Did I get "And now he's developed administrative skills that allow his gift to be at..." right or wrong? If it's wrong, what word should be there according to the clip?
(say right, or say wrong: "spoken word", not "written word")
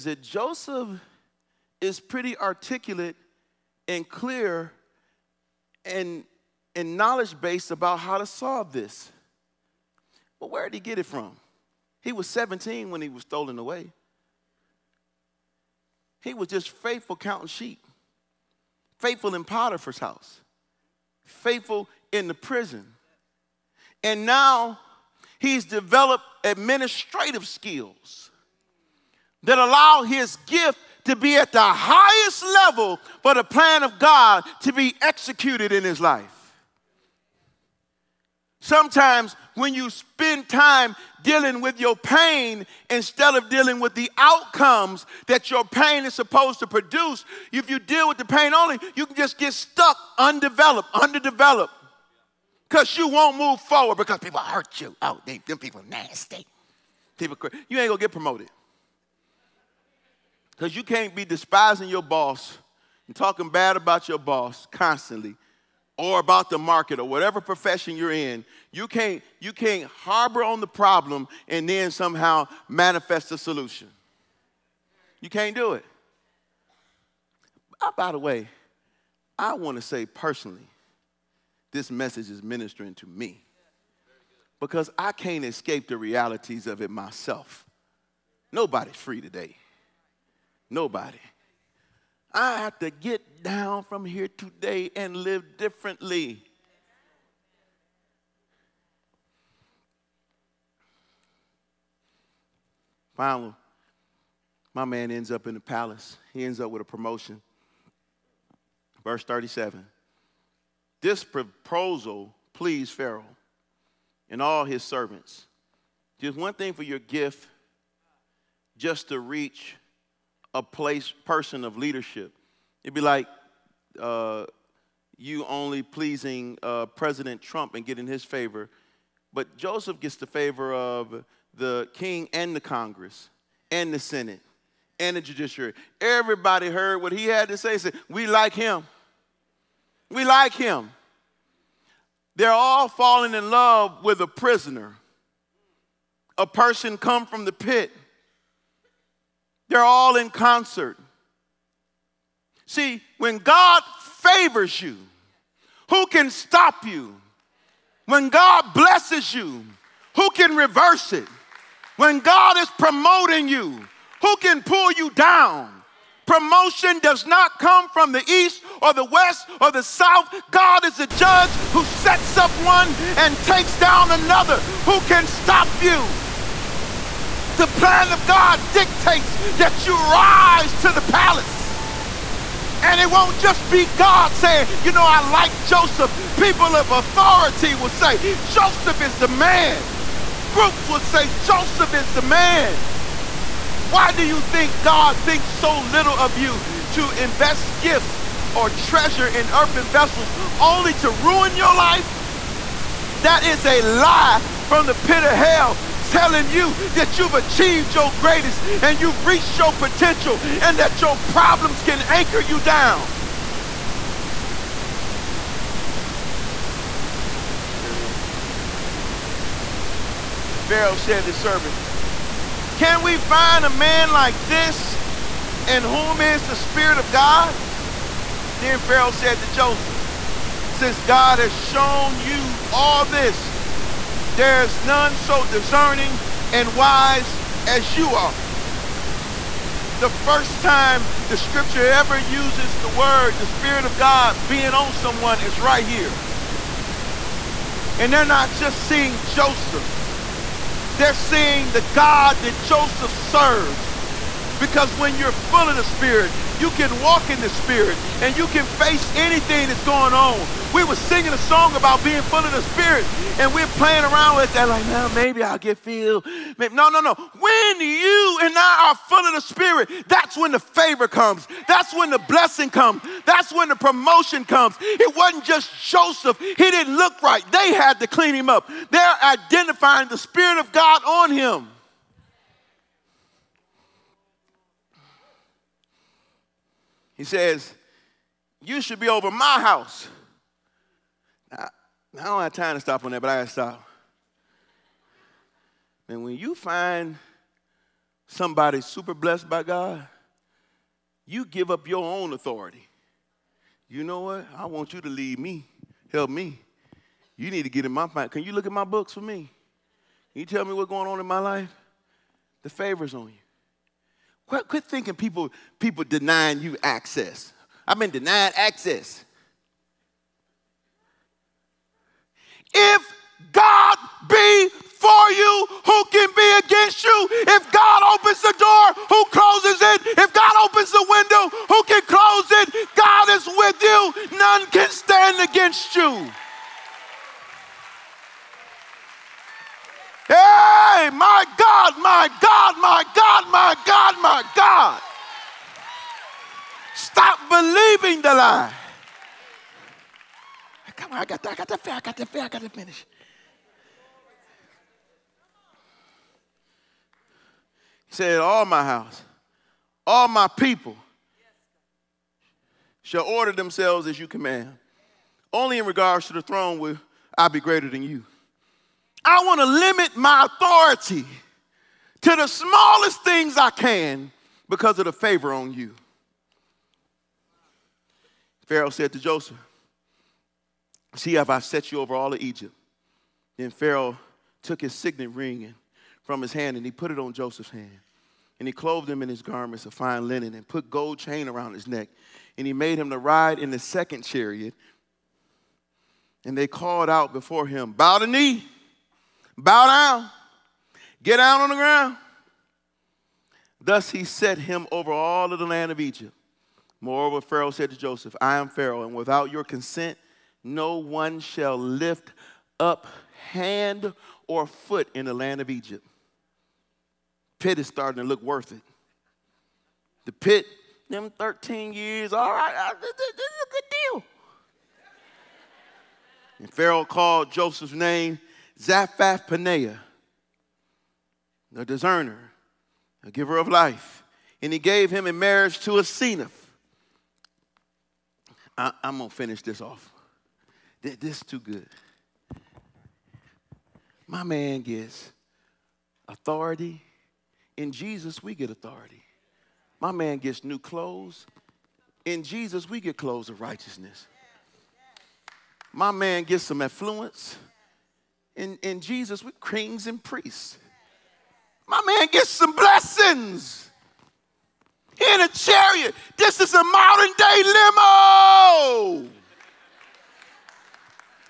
right.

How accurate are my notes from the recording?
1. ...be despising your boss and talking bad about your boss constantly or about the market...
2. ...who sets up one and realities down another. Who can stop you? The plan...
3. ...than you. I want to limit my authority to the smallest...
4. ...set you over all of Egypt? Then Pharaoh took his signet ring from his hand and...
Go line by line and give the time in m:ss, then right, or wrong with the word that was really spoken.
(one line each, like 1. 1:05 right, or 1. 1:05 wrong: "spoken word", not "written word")
1. 1:01 right
2. 2:51 wrong: "takes", not "realities"
3. 6:07 right
4. 6:21 right.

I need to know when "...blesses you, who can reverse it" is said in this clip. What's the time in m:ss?
2:38.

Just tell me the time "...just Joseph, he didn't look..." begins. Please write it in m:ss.
4:35.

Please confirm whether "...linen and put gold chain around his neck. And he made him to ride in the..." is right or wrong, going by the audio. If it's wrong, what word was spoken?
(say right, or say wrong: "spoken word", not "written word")
right.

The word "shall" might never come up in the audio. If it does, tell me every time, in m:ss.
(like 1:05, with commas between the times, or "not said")
6:03, 6:51.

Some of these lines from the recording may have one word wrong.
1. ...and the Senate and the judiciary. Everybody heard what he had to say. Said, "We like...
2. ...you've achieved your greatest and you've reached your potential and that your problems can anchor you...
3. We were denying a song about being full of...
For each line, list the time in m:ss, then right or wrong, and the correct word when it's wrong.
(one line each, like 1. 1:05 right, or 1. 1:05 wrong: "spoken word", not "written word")
1. 2:13 right
2. 3:27 right
3. 4:20 wrong: "singing", not "denying".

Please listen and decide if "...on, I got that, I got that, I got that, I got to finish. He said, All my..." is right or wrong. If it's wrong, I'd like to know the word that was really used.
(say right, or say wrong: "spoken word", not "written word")
right.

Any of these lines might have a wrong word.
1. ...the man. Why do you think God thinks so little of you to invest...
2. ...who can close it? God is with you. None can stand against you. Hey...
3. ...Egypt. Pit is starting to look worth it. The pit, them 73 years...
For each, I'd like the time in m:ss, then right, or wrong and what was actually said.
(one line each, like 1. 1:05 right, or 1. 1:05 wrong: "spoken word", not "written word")
1. 3:12 right
2. 5:31 right
3. 6:55 wrong: "13", not "73".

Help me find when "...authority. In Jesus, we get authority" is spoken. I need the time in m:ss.
7:26.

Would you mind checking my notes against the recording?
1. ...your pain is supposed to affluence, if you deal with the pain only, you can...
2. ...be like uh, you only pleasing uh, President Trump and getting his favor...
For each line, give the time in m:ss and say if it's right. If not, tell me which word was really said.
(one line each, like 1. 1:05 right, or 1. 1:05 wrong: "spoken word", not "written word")
1. 0:45 wrong: "produce", not "affluence"
2. 2:02 right.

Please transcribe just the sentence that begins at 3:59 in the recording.
The first time the scripture ever uses the word, the Spirit of God being on someone, is right here.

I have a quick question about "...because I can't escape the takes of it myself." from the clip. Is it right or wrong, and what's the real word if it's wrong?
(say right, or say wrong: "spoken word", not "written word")
wrong: "realities", not "takes".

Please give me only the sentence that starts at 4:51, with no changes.
Now, I don't have time to stop on that, but I gotta stop.